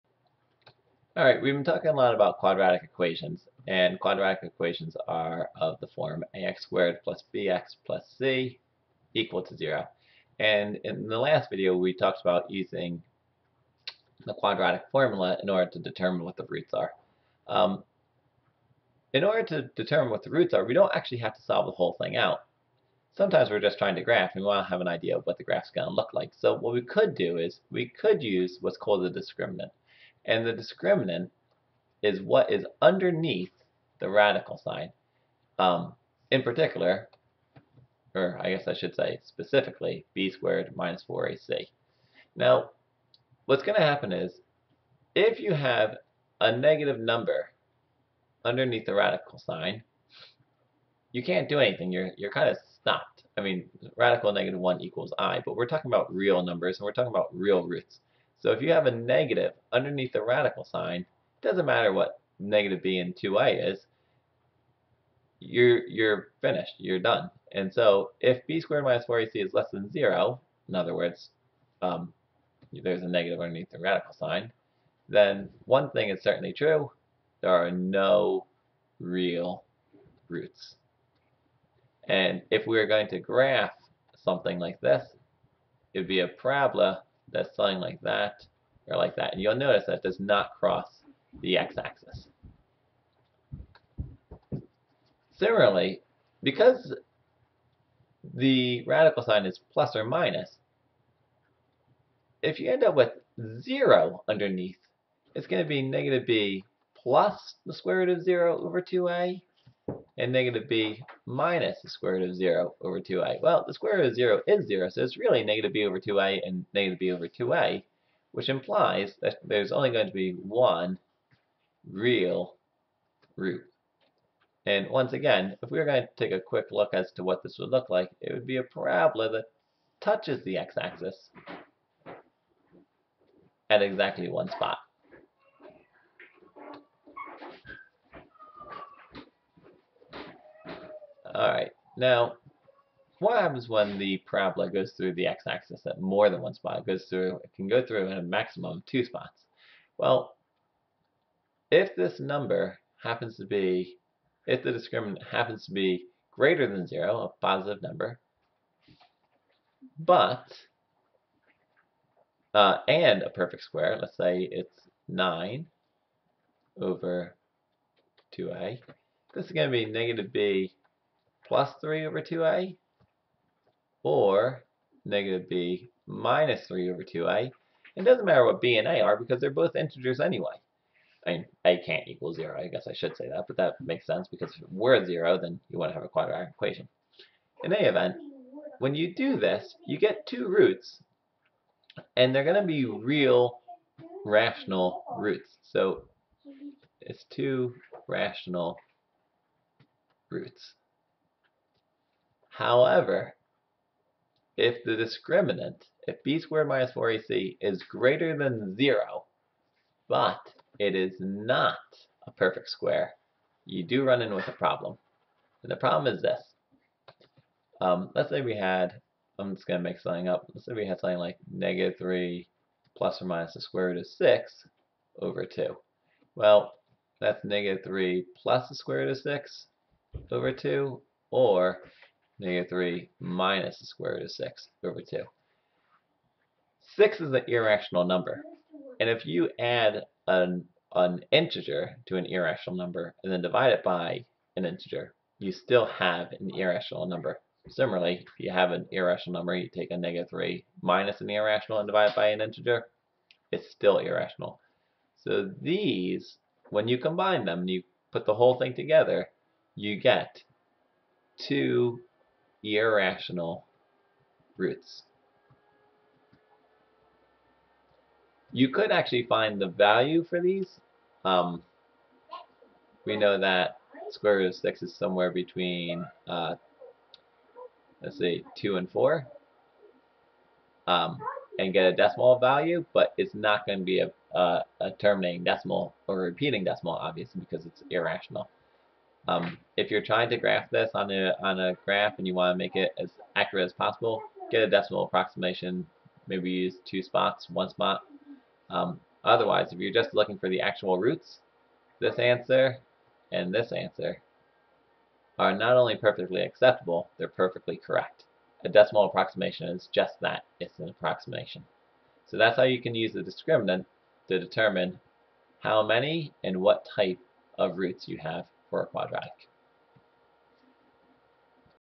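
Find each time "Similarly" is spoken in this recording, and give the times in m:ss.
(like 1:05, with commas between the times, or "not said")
1:35, 4:07.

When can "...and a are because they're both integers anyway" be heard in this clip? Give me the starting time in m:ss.
2:58.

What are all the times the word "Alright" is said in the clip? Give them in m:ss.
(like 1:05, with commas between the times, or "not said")
0:01, 2:21.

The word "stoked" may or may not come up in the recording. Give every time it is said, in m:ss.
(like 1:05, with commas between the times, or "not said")
not said.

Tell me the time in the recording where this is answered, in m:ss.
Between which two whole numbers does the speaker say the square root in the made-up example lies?
4:38.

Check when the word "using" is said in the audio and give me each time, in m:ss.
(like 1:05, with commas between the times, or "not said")
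0:12.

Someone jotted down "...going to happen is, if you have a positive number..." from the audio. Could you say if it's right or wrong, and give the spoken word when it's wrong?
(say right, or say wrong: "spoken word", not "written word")
wrong: "negative", not "positive".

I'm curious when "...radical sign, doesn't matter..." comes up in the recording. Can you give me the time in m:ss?
1:00.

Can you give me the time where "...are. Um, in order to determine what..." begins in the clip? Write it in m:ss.
0:16.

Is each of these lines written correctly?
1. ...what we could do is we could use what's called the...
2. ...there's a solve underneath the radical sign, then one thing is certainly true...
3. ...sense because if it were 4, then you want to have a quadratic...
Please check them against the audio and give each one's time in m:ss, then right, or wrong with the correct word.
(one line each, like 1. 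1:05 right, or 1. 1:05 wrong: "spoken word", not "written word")
1. 0:26 right
2. 1:12 wrong: "negative", not "solve"
3. 3:04 wrong: "0", not "4".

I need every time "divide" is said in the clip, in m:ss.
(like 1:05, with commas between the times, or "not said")
4:03, 4:11.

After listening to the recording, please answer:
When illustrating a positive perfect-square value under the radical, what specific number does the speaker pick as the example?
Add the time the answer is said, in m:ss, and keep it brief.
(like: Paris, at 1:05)
9, at 2:45.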